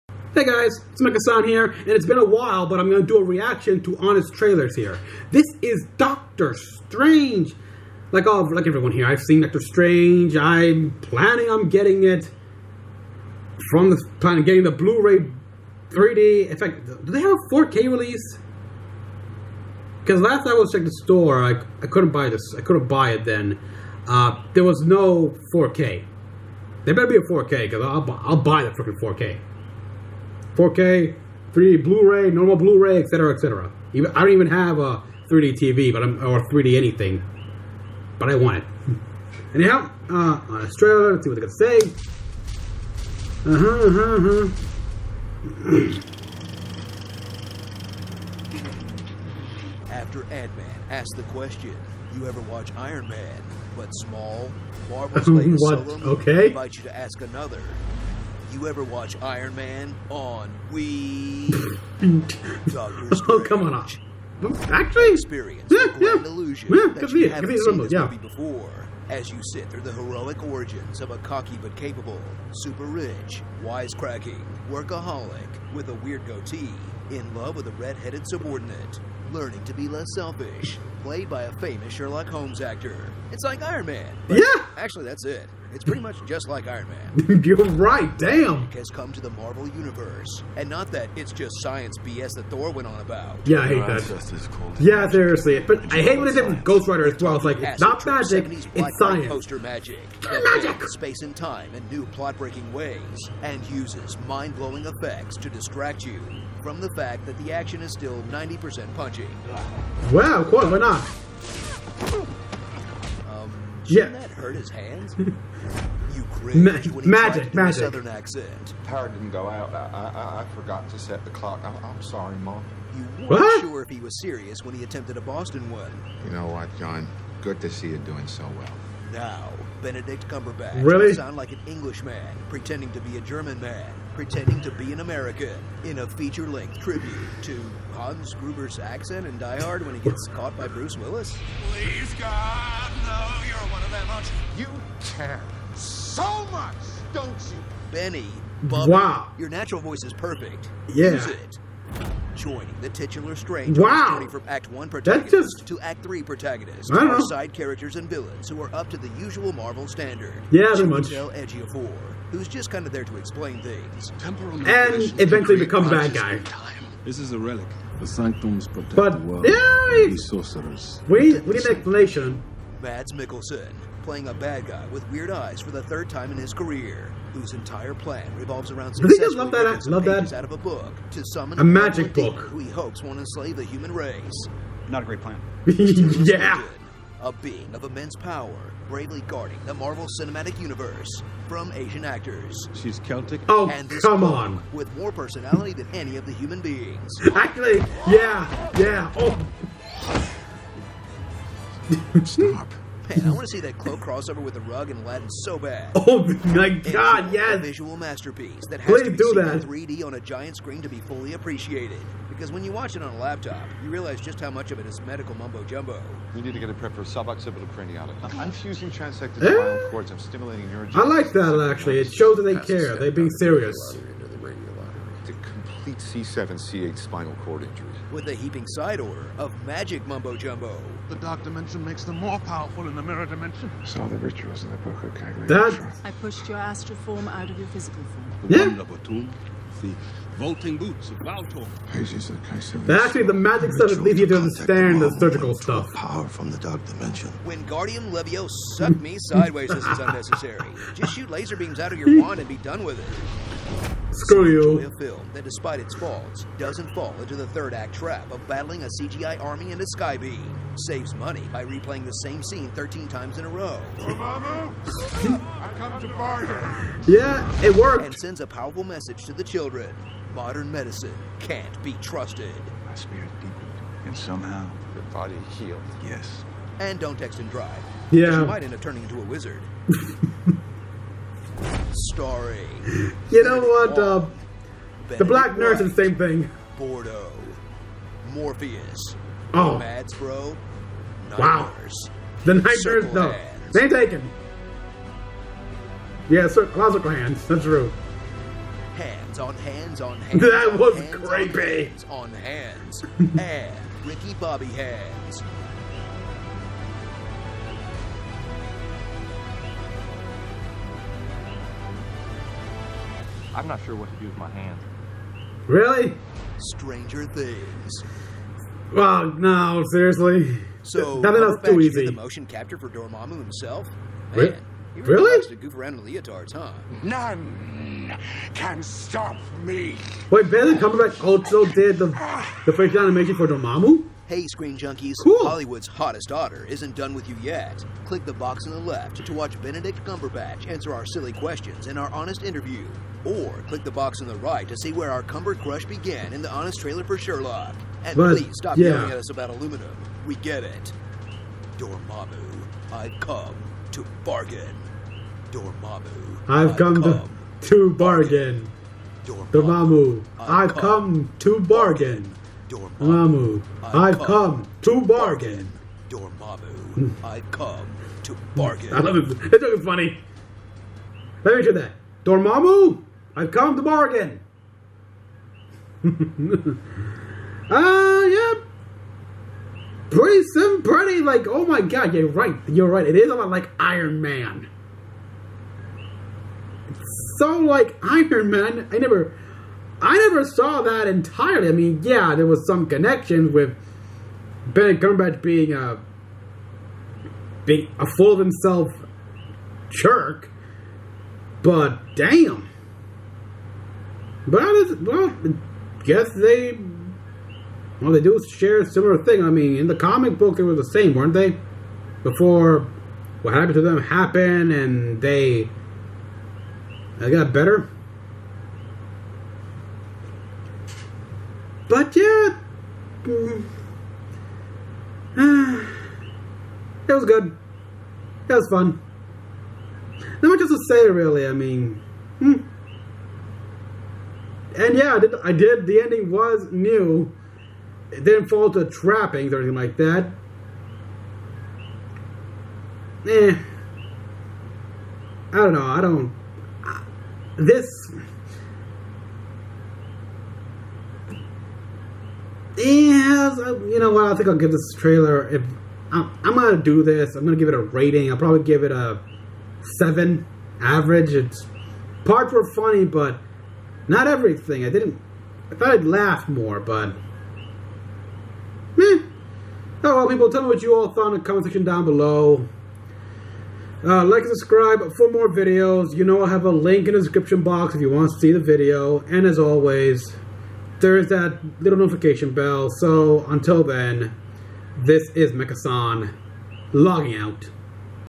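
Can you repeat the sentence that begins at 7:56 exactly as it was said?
You know I have a link in the description box if you want to see the video.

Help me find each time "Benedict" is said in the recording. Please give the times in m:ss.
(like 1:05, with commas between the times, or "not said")
2:09, 5:30, 5:39.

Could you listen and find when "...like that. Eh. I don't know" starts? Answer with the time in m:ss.
7:19.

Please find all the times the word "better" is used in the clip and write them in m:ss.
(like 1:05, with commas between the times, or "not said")
0:26, 6:57.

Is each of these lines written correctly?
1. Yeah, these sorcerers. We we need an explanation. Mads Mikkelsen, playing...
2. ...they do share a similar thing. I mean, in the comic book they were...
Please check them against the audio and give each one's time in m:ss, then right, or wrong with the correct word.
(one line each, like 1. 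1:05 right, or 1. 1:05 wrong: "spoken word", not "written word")
1. 2:49 right
2. 6:48 right.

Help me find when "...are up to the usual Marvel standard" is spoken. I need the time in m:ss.
2:38.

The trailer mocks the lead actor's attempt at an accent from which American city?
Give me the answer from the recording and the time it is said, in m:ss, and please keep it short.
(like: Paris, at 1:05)
Boston, at 2:05.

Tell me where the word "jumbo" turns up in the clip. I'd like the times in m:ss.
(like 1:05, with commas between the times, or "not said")
3:35, 3:50.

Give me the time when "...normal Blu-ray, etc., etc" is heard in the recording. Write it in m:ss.
0:32.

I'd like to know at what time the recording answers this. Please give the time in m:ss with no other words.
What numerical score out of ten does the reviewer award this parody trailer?
7:39.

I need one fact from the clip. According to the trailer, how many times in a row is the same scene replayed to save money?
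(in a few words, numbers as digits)
13.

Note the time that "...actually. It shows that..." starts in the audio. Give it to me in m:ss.
3:41.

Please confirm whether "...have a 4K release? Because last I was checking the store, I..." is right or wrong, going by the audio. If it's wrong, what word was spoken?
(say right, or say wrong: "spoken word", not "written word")
right.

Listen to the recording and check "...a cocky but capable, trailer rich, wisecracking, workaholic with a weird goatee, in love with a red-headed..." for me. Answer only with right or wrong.
wrong.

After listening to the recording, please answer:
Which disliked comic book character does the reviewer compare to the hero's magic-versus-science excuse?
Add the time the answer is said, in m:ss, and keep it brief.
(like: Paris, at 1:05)
Ghost Rider, at 1:36.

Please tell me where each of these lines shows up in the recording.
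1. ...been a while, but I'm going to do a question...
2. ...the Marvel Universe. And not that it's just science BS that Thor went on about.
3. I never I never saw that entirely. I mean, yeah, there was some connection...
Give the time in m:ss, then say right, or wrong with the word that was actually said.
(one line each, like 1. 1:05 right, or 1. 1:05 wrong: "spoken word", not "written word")
1. 0:02 wrong: "reaction", not "question"
2. 1:29 right
3. 6:28 right.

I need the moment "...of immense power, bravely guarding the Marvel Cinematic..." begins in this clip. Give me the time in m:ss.
3:07.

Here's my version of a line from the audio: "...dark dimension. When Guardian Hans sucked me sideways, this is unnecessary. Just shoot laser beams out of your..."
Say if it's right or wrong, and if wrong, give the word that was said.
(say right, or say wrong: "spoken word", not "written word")
wrong: "Levio", not "Hans".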